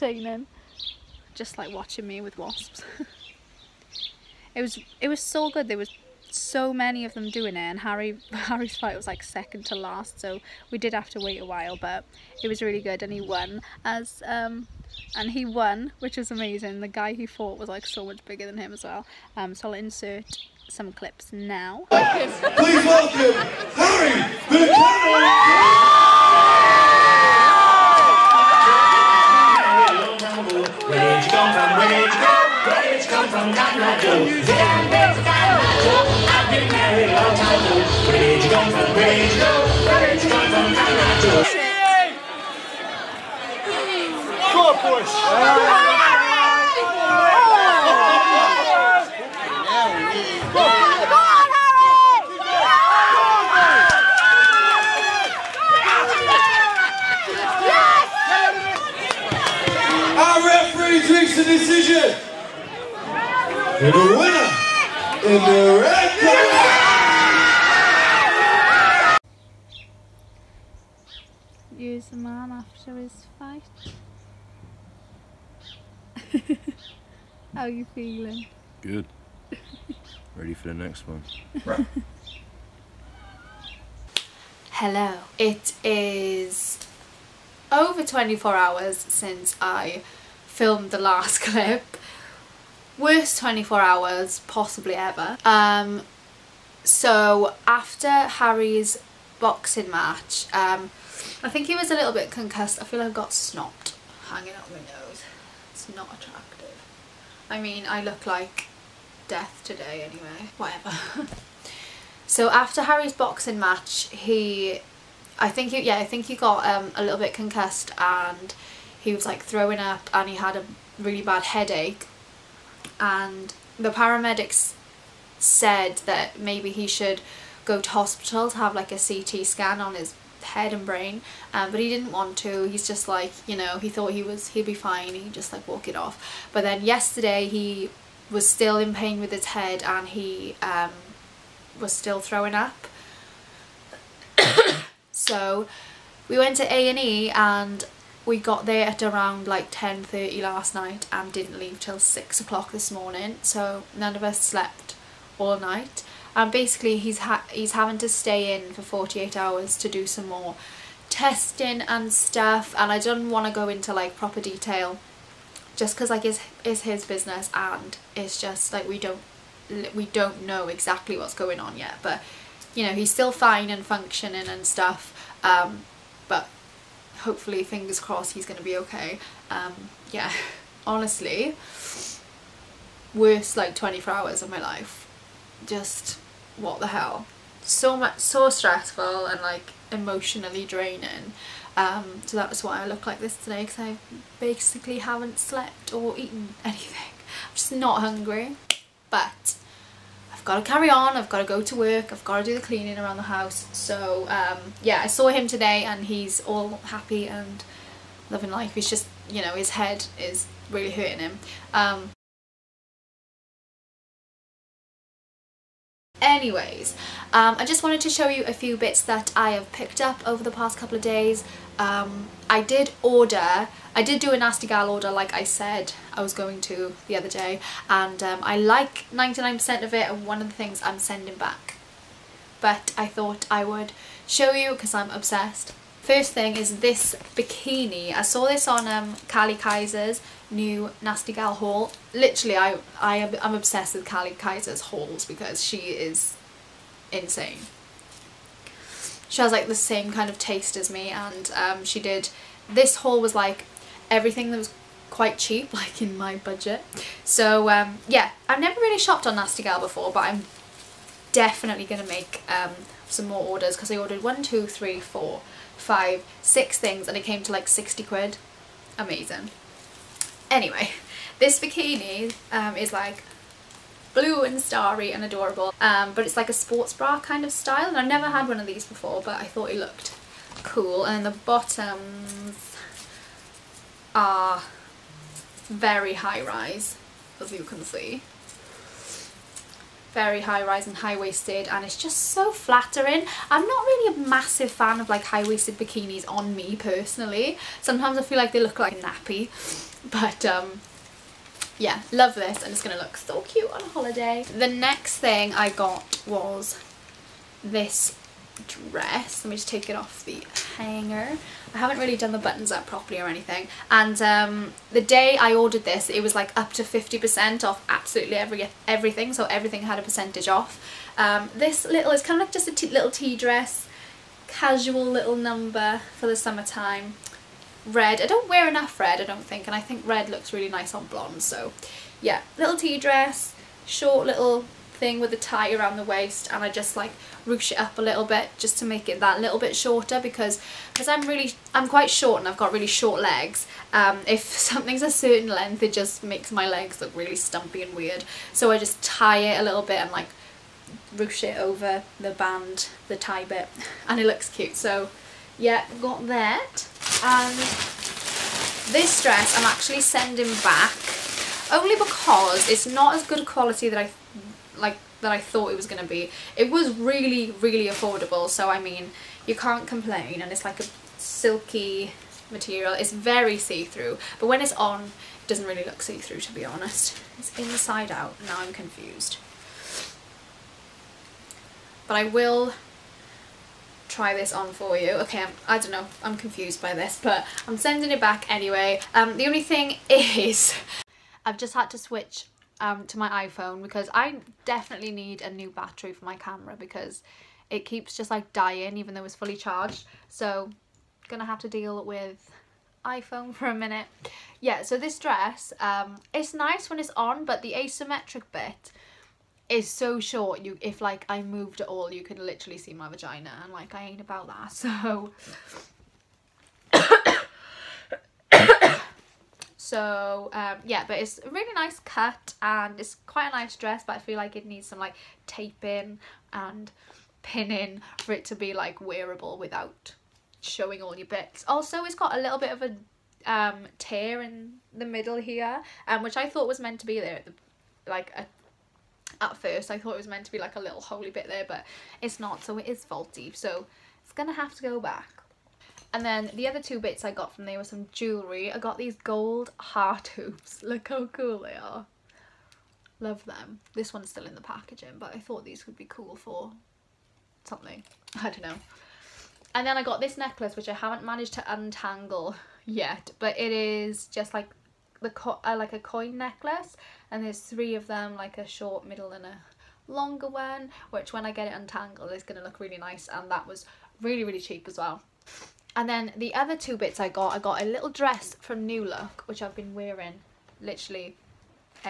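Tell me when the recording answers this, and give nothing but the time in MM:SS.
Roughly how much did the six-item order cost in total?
04:27.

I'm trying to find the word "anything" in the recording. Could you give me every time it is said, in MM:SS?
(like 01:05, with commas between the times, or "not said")
03:16, 05:13.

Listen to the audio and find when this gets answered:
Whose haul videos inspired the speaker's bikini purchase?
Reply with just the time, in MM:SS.
04:04.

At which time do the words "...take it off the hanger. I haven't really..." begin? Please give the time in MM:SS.
05:09.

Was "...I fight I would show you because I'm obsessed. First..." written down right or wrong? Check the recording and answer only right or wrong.
wrong.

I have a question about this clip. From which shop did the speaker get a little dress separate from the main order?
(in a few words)
New Look.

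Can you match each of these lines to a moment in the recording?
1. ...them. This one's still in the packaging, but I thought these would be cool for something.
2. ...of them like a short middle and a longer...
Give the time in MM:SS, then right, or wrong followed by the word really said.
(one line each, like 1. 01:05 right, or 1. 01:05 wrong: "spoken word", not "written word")
1. 07:33 right
2. 07:47 right.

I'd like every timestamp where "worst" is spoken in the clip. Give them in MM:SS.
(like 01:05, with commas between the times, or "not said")
01:32, 03:03.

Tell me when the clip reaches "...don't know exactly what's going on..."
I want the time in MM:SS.
02:50.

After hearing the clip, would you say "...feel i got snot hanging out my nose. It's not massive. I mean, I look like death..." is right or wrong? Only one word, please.
wrong.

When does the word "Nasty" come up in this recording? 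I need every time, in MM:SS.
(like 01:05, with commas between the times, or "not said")
03:44, 04:01, 04:19.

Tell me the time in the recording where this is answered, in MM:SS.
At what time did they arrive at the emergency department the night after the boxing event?
02:29.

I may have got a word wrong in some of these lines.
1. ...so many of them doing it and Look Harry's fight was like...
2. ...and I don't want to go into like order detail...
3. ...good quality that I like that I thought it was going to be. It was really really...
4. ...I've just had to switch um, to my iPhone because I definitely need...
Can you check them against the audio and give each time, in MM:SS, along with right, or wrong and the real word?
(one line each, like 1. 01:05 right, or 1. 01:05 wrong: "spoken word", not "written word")
1. 00:06 wrong: "Harry", not "Look"
2. 02:42 wrong: "proper", not "order"
3. 06:03 right
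4. 06:31 right.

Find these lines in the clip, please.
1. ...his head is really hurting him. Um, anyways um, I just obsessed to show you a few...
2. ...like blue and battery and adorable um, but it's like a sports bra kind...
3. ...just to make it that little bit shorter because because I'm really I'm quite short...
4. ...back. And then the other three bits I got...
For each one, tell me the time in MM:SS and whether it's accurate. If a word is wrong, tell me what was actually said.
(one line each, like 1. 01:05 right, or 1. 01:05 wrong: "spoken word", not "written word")
1. 03:29 wrong: "wanted", not "obsessed"
2. 04:32 wrong: "starry", not "battery"
3. 05:38 right
4. 07:24 wrong: "two", not "three".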